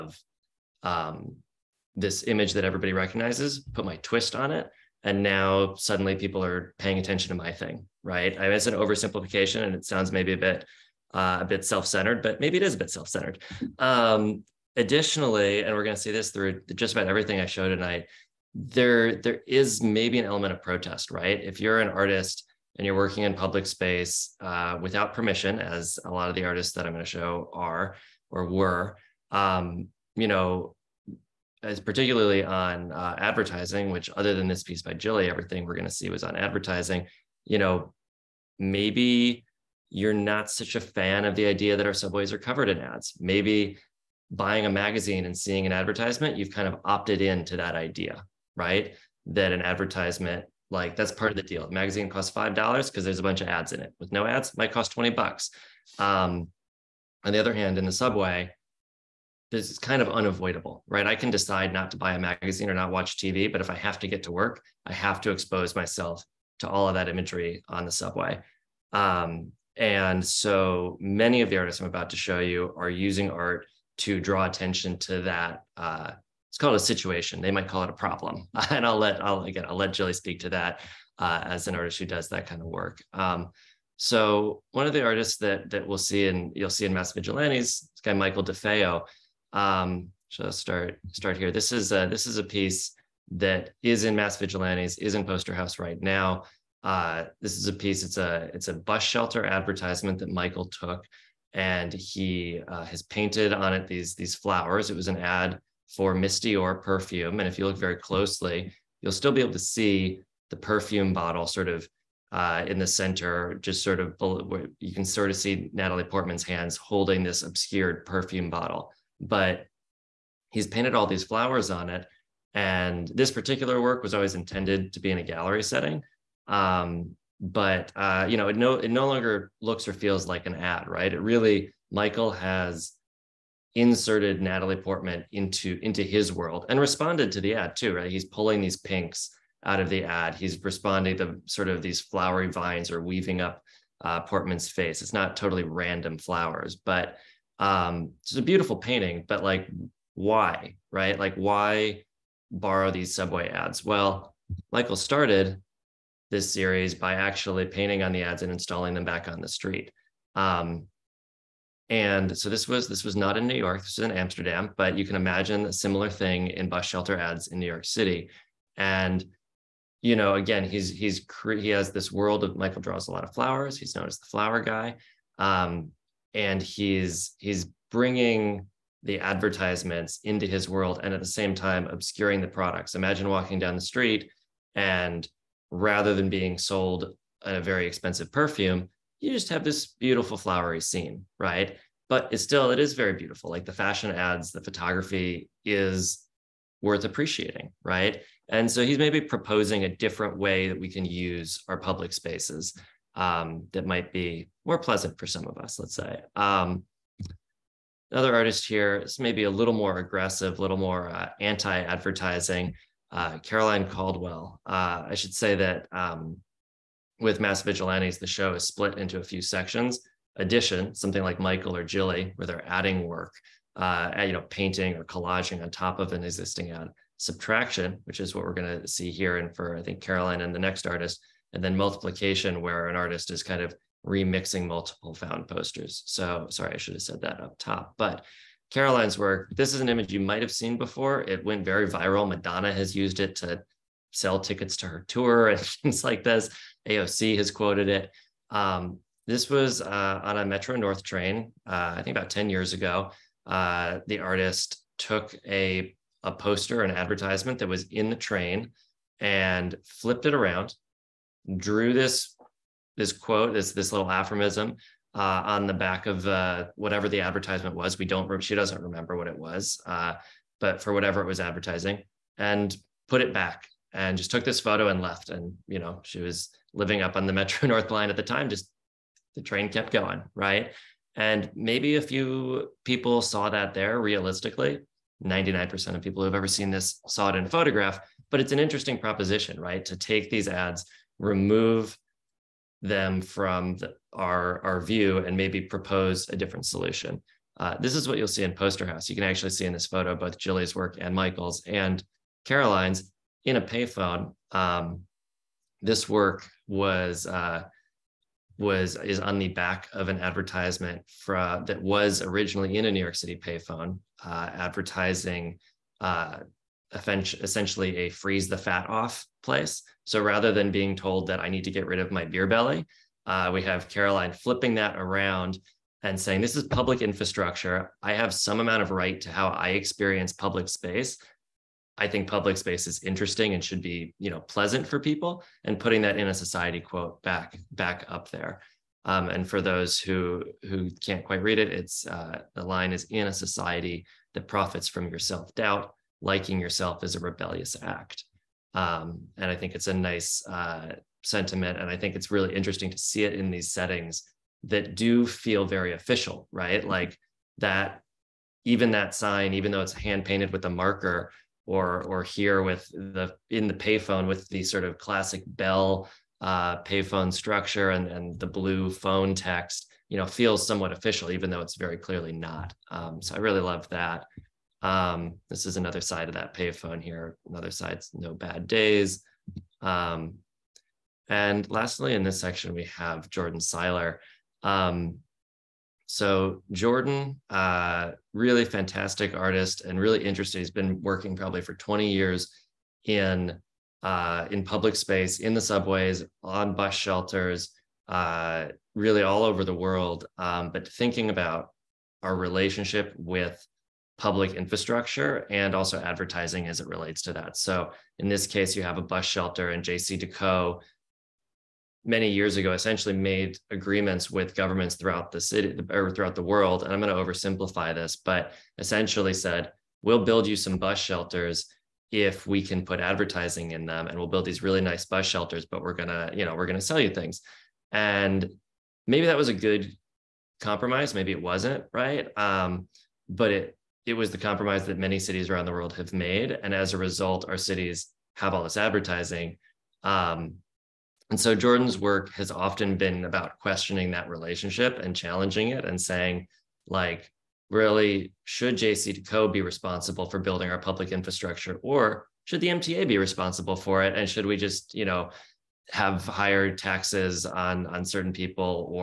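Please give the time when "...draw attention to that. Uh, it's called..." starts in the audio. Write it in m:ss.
1:14.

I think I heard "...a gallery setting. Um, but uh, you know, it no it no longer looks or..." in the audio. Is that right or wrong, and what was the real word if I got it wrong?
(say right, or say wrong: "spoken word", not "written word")
right.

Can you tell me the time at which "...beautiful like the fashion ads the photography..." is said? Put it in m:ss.
3:13.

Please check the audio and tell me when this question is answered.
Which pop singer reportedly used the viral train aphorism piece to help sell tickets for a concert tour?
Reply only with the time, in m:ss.
4:02.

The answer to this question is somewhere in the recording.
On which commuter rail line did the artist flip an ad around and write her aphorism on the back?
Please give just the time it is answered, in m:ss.
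4:10.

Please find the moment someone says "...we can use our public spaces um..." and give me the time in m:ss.
3:20.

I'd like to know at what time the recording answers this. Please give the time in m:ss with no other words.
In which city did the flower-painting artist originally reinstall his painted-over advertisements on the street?
2:44.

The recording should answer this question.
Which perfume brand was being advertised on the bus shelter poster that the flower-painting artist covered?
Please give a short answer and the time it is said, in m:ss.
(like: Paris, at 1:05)
Miss Dior, at 1:46.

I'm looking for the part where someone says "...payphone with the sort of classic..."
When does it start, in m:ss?
6:03.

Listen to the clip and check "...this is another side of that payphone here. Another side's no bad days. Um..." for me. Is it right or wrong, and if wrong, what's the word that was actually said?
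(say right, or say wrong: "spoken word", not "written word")
right.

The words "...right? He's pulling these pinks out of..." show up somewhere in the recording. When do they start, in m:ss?
2:17.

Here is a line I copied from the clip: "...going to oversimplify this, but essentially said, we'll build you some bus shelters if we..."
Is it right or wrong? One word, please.
right.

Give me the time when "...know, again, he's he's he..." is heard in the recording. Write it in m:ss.
2:50.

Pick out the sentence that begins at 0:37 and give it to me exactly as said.
You know, maybe you're not such a fan of the idea that our subways are covered in ads.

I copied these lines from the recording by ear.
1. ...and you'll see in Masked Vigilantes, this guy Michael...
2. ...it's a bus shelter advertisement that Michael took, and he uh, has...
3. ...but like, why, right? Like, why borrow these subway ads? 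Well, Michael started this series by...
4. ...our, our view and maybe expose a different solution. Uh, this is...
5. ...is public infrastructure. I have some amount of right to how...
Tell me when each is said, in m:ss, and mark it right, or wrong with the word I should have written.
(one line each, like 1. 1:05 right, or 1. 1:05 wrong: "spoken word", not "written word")
1. 1:26 right
2. 1:38 right
3. 2:29 right
4. 4:54 wrong: "propose", not "expose"
5. 5:26 right.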